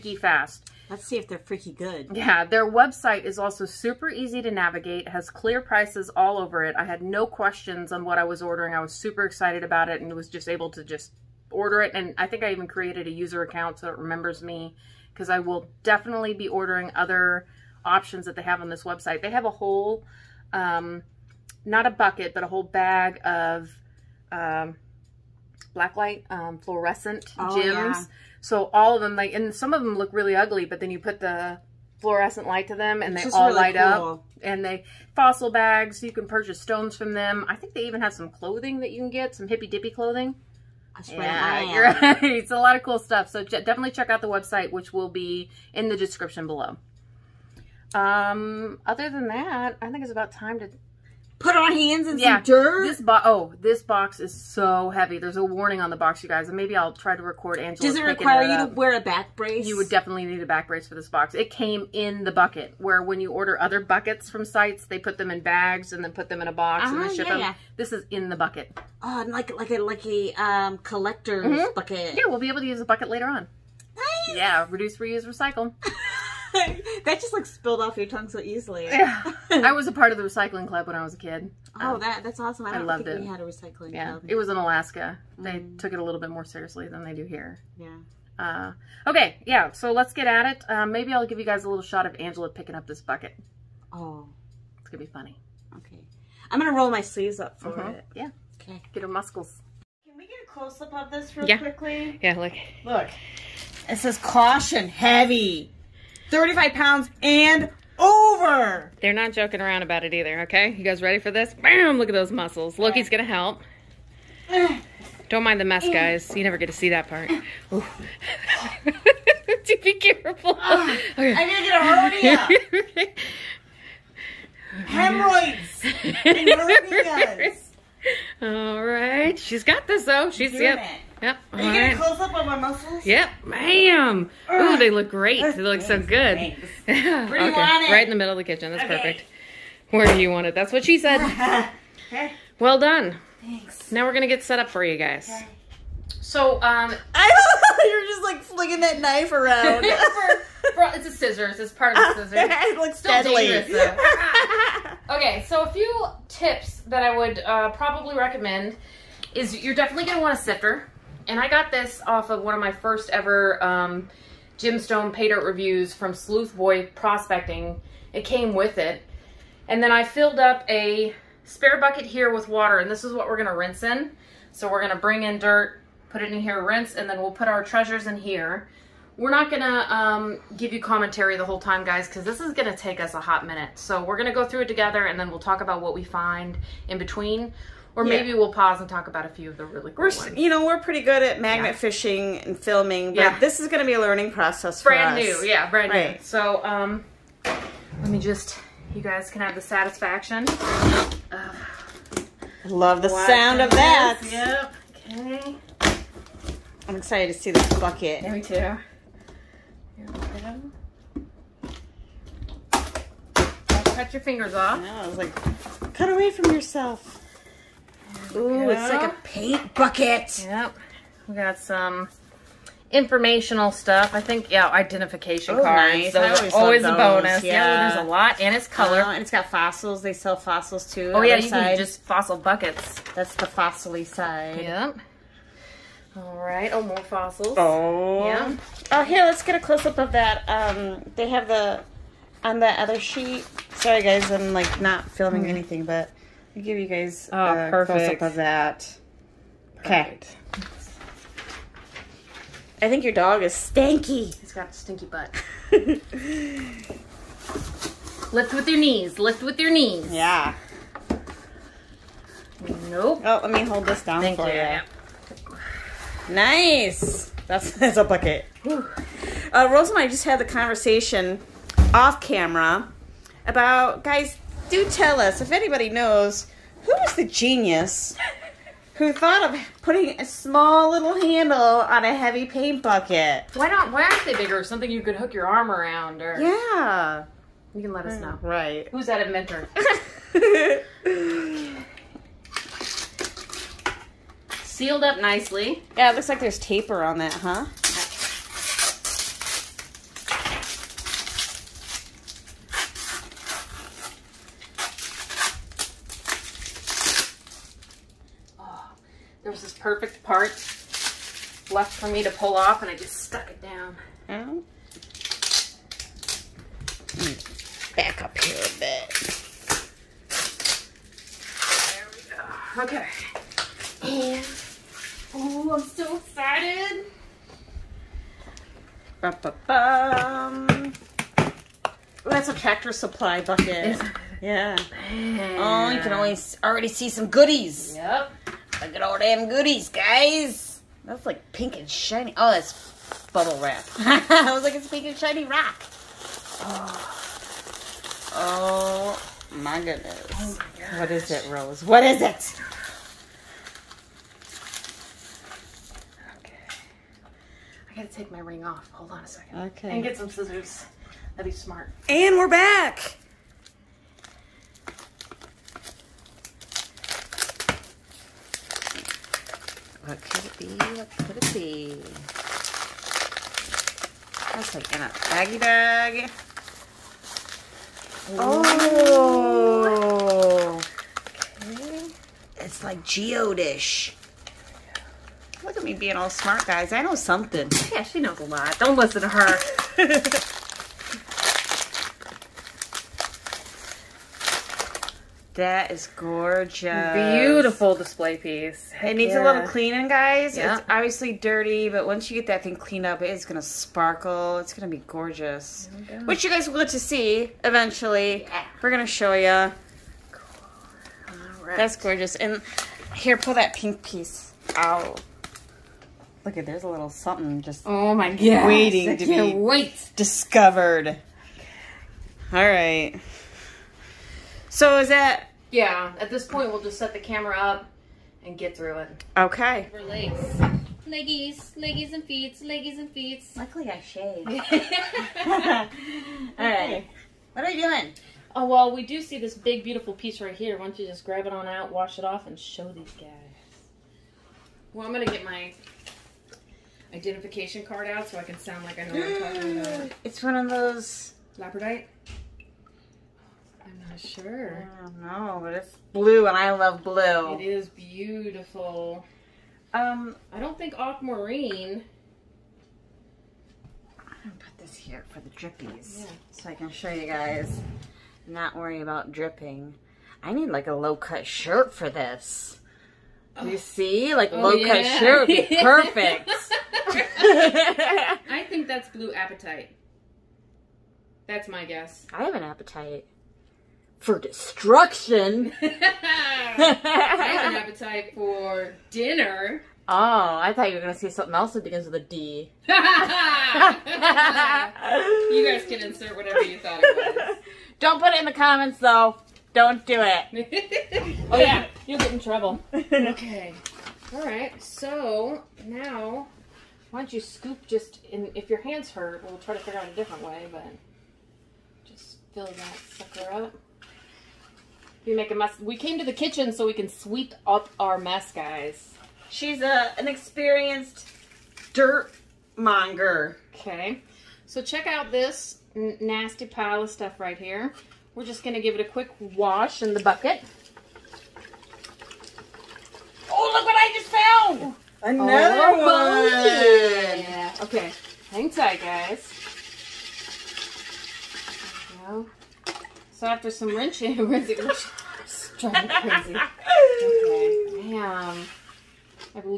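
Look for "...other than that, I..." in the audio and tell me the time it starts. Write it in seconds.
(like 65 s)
48 s.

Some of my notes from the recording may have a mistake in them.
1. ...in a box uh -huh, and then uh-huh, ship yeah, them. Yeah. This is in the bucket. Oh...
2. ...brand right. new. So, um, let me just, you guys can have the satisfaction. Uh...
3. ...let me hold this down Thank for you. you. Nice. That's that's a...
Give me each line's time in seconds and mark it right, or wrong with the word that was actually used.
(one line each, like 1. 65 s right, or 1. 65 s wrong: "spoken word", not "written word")
1. 66 s right
2. 195 s right
3. 263 s right.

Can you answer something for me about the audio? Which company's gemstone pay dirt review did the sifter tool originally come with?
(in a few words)
Sleuth Boy Prospecting.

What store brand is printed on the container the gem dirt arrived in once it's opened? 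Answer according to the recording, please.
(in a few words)
Tractor Supply.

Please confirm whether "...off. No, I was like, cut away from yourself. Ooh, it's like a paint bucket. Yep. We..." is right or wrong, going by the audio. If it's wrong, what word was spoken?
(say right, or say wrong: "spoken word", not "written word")
right.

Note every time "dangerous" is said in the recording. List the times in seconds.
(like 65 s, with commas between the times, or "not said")
153 s.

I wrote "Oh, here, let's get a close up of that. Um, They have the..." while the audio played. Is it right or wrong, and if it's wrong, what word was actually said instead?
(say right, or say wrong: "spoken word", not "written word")
right.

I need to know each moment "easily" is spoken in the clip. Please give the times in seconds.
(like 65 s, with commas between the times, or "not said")
78 s.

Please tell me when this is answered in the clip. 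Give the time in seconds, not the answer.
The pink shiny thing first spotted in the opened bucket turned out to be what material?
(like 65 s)
343 s.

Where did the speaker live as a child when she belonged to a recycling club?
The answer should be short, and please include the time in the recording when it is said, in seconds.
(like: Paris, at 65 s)
Alaska, at 84 s.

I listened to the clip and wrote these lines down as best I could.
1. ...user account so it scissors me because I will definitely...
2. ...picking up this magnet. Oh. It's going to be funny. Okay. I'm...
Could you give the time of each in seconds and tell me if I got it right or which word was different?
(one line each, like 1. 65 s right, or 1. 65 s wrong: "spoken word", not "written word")
1. 13 s wrong: "remembers", not "scissors"
2. 92 s wrong: "bucket", not "magnet".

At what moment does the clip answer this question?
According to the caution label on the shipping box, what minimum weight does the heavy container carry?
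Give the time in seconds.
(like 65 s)
106 s.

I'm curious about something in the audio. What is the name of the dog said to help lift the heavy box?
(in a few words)
Loki.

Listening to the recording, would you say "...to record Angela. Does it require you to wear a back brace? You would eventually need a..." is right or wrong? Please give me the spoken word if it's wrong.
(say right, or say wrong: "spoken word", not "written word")
wrong: "definitely", not "eventually".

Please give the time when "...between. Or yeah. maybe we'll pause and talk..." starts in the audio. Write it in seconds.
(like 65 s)
186 s.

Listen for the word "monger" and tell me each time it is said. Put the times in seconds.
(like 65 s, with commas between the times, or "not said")
522 s.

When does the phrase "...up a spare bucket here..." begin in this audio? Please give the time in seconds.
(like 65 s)
170 s.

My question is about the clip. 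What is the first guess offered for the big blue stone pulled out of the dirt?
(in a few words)
Labradorite.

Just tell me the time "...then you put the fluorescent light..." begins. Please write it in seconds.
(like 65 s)
30 s.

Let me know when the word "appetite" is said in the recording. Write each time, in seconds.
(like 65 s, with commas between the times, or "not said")
482 s, 487 s.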